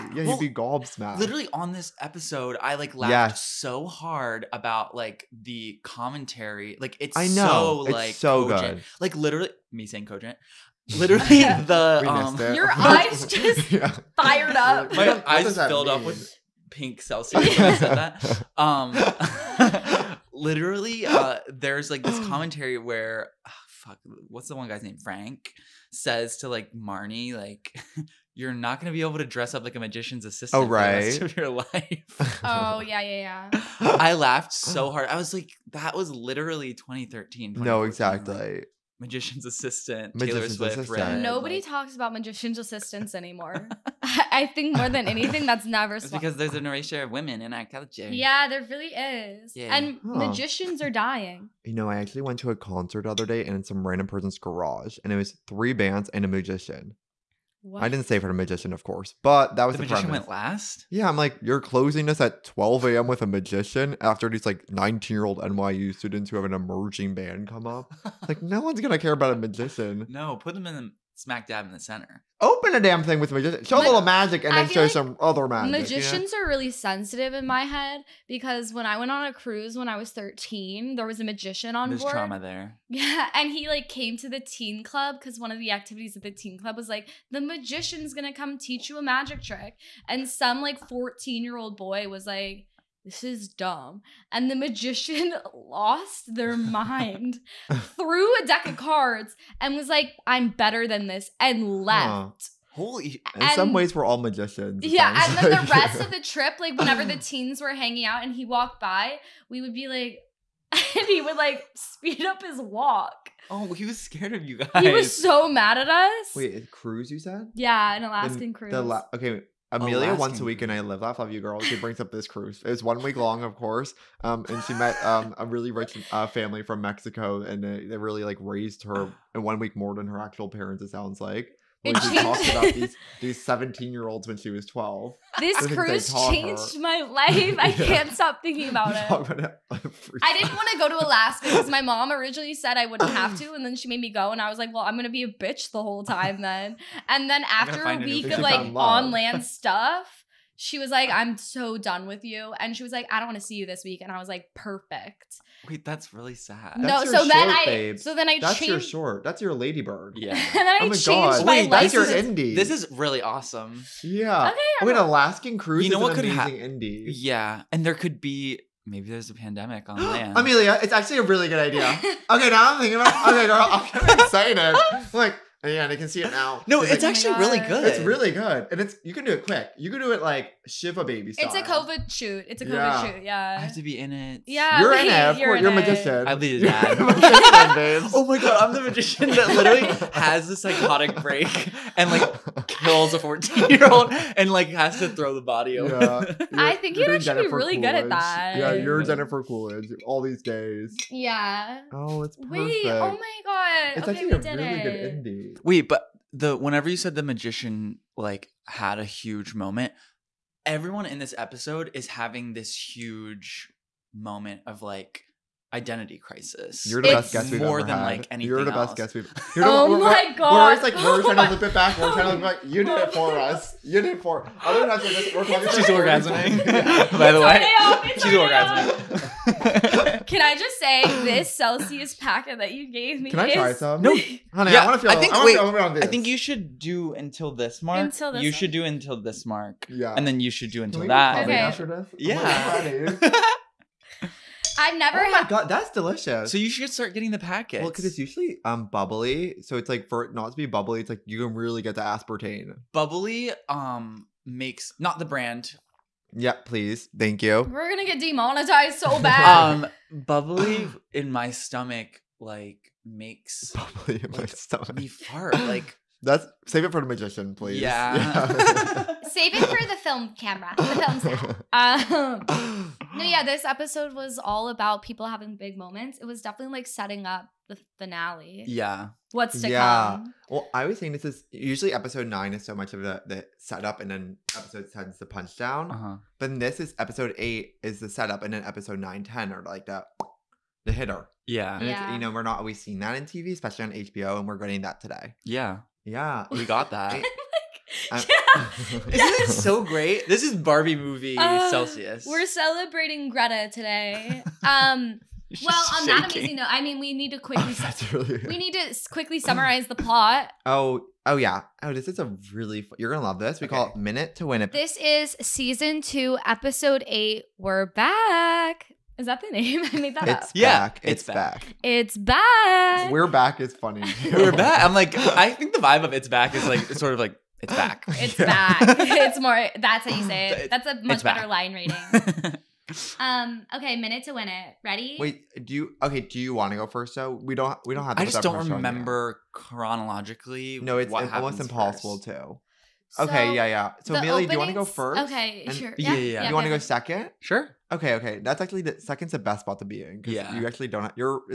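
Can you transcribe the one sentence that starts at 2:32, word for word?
And she was like, I don't want to see you this week.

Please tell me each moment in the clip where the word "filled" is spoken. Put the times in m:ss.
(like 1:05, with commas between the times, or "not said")
0:15.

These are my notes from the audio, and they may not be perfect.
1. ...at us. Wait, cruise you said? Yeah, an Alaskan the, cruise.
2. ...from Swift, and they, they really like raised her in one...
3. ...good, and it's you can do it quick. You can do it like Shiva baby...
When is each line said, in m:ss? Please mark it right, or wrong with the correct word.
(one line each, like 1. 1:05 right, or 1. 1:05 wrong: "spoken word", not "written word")
1. 1:55 right
2. 2:06 wrong: "Mexico", not "Swift"
3. 2:58 right.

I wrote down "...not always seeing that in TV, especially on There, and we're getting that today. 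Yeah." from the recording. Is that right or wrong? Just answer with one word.
wrong.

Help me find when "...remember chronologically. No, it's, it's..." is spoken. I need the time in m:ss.
5:38.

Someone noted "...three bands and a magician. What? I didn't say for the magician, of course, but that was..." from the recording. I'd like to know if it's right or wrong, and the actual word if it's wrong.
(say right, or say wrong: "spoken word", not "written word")
right.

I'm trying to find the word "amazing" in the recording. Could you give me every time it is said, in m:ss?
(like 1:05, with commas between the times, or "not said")
2:46, 5:06.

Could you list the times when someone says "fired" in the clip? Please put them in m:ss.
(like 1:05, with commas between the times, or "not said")
0:14.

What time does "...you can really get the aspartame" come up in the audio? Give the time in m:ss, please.
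4:11.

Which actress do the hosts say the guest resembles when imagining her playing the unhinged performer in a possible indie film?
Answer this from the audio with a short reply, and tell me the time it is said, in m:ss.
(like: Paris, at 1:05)
Jennifer Coolidge, at 3:19.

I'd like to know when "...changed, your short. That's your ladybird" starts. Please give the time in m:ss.
2:38.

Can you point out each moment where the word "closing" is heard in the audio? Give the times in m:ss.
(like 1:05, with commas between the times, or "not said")
1:01.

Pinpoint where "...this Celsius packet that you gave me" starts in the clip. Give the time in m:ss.
3:51.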